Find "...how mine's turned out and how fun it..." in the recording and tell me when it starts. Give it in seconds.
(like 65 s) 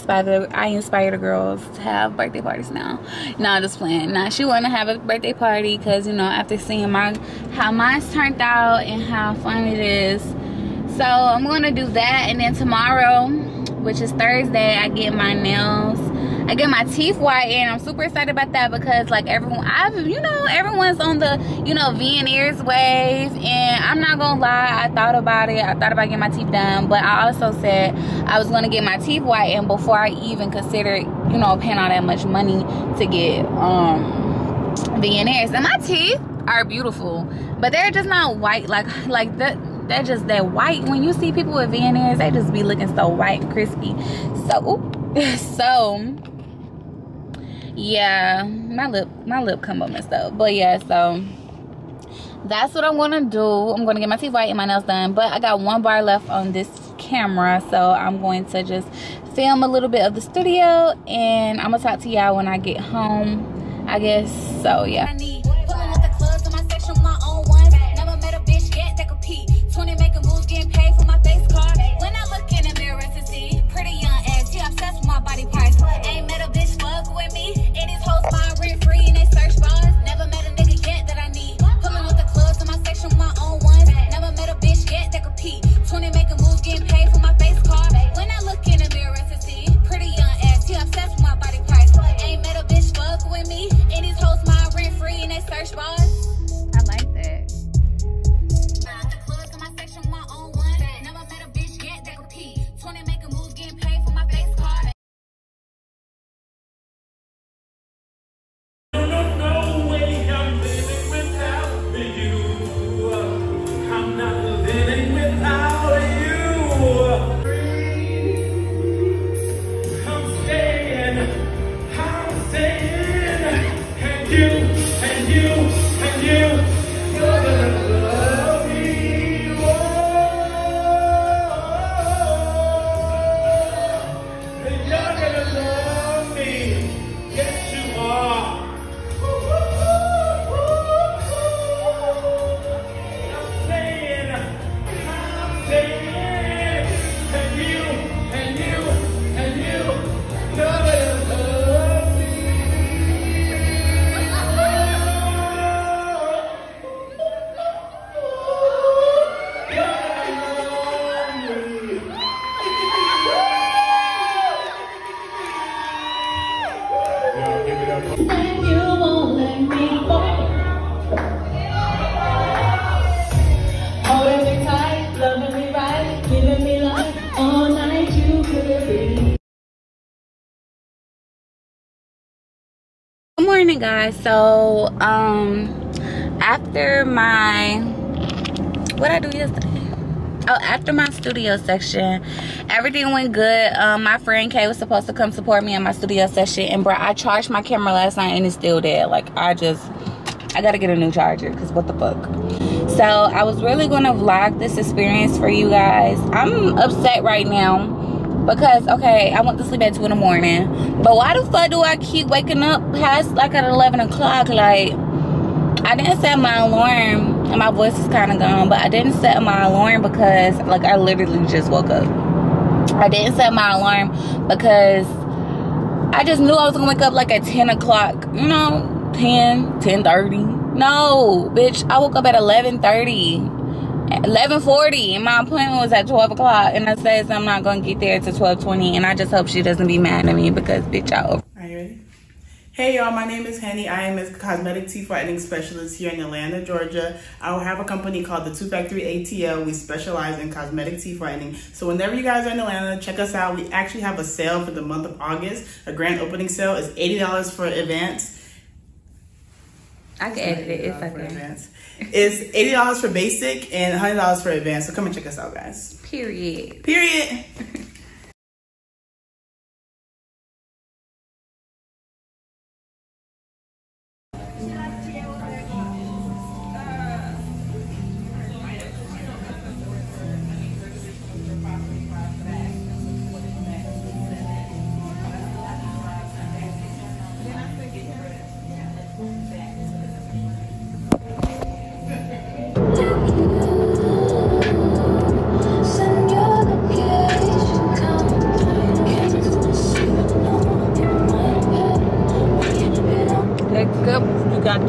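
7 s.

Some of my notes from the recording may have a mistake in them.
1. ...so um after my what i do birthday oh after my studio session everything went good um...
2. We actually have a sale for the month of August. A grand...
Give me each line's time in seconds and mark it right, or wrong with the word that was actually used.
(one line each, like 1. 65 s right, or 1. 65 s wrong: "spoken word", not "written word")
1. 184 s wrong: "yesterday", not "birthday"
2. 253 s right.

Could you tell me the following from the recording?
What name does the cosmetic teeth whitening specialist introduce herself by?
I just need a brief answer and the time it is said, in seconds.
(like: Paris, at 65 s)
Henny, at 243 s.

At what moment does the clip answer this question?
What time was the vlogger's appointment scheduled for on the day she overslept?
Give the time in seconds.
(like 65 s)
236 s.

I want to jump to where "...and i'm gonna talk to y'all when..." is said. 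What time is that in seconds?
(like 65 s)
61 s.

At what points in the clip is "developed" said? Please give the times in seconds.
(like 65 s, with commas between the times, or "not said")
not said.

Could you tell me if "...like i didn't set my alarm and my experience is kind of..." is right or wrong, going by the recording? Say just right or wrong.
wrong.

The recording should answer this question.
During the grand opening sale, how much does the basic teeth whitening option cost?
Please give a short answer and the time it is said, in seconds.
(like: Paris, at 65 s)
$80, at 262 s.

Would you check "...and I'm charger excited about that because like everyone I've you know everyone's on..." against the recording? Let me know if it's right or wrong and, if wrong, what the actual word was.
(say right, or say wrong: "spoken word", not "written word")
wrong: "super", not "charger".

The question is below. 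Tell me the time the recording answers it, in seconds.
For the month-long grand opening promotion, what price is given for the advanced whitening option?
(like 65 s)
263 s.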